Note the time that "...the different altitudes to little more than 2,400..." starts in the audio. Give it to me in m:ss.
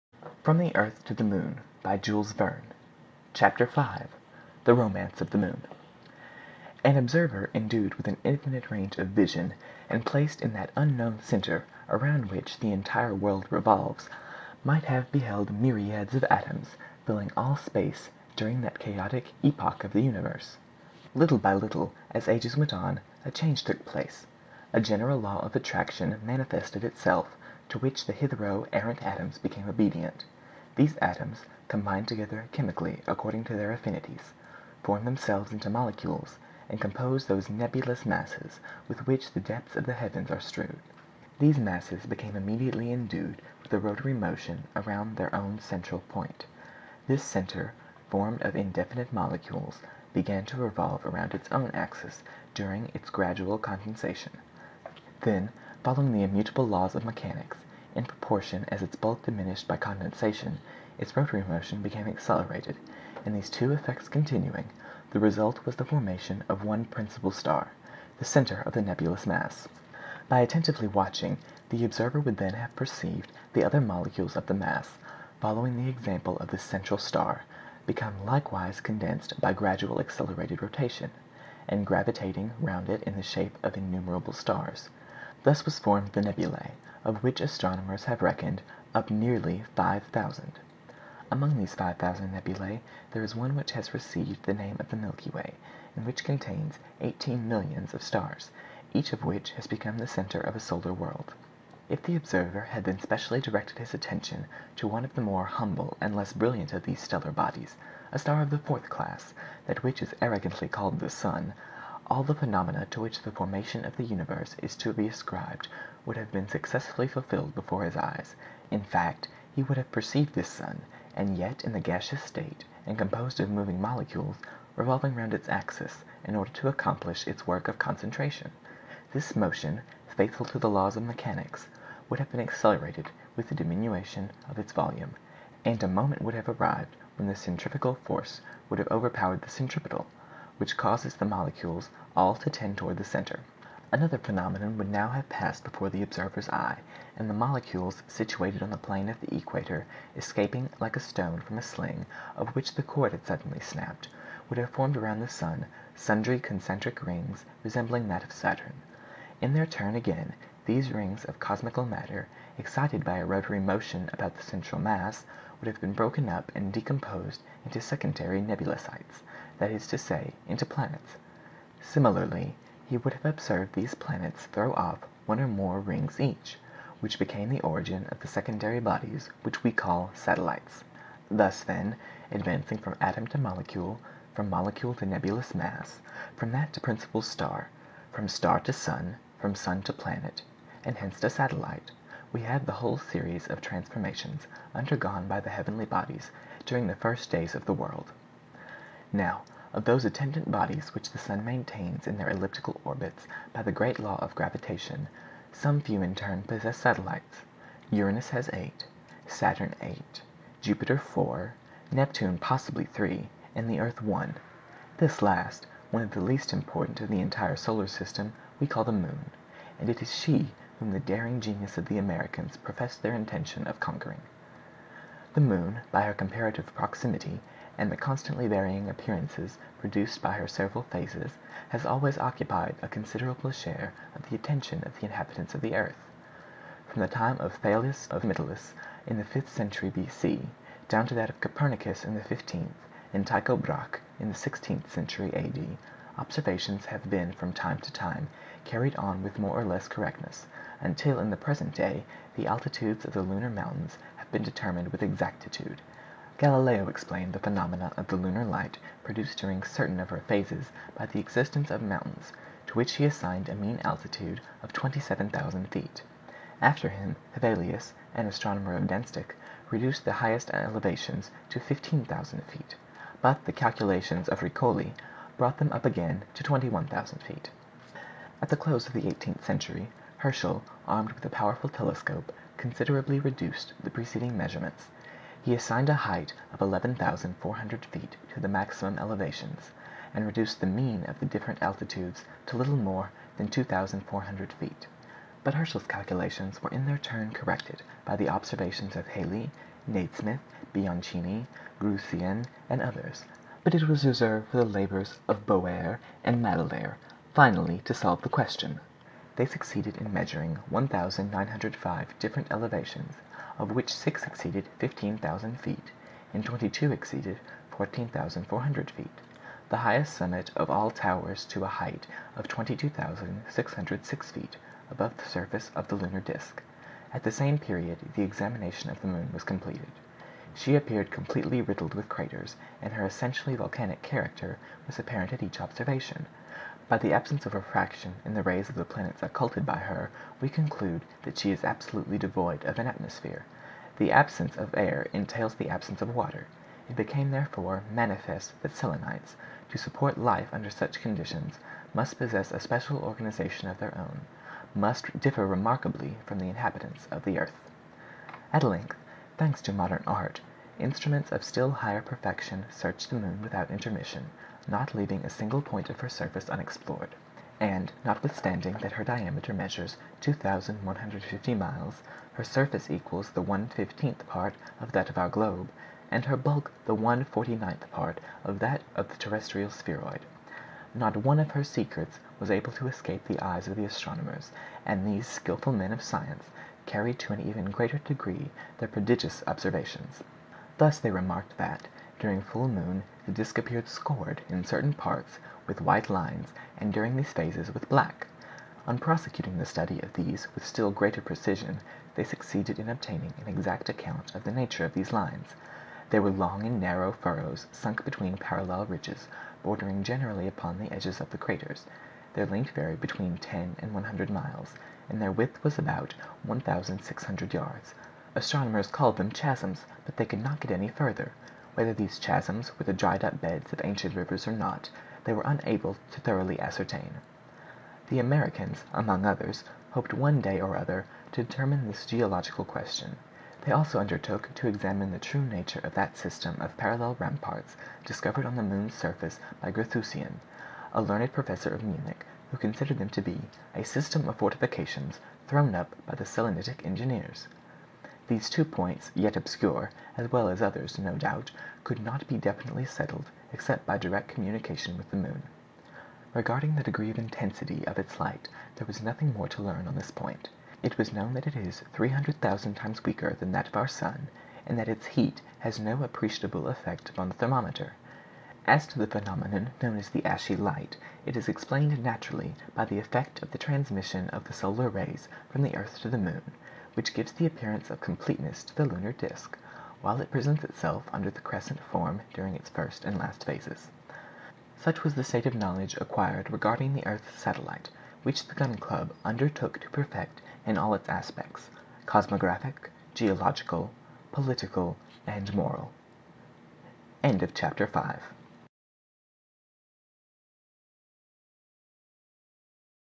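4:51.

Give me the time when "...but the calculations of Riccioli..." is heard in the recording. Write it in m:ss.
4:33.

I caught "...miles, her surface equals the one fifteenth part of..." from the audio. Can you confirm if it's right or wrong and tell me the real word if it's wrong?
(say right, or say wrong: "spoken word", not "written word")
right.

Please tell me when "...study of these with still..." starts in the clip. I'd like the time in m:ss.
6:39.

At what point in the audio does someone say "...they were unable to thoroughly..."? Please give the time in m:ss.
7:05.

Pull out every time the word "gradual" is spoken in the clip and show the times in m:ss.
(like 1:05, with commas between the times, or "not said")
0:53, 1:19.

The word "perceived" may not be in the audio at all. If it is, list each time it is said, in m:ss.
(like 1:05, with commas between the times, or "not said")
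1:12, 1:59.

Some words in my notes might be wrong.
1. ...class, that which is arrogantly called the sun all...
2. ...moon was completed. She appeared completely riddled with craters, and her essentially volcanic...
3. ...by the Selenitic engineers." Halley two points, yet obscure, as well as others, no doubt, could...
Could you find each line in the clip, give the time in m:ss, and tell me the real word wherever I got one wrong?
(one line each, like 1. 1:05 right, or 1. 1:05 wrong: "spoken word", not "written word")
1. 1:48 right
2. 5:29 right
3. 7:26 wrong: "These", not "Halley".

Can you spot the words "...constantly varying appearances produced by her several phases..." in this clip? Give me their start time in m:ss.
3:47.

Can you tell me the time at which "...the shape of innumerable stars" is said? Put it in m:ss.
1:23.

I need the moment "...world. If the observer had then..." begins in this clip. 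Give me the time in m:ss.
1:40.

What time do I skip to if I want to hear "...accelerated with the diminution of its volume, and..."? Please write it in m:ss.
2:12.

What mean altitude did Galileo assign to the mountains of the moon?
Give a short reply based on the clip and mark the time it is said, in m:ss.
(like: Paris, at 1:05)
27,000 feet, at 4:24.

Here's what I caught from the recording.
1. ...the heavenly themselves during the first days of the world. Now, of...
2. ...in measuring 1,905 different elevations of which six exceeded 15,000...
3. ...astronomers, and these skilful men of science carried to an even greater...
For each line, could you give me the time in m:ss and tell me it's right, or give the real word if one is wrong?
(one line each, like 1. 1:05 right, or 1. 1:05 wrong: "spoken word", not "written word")
1. 3:15 wrong: "bodies", not "themselves"
2. 5:09 right
3. 6:23 right.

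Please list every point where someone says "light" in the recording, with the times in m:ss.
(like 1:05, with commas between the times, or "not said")
4:18, 7:38, 7:50.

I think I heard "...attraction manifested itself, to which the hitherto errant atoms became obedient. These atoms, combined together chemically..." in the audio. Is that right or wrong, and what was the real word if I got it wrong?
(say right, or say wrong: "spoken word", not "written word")
right.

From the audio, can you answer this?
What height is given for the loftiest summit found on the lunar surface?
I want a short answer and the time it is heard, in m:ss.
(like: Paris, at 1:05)
22,606 feet, at 5:22.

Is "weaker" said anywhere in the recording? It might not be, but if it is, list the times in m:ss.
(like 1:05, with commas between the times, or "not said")
7:43.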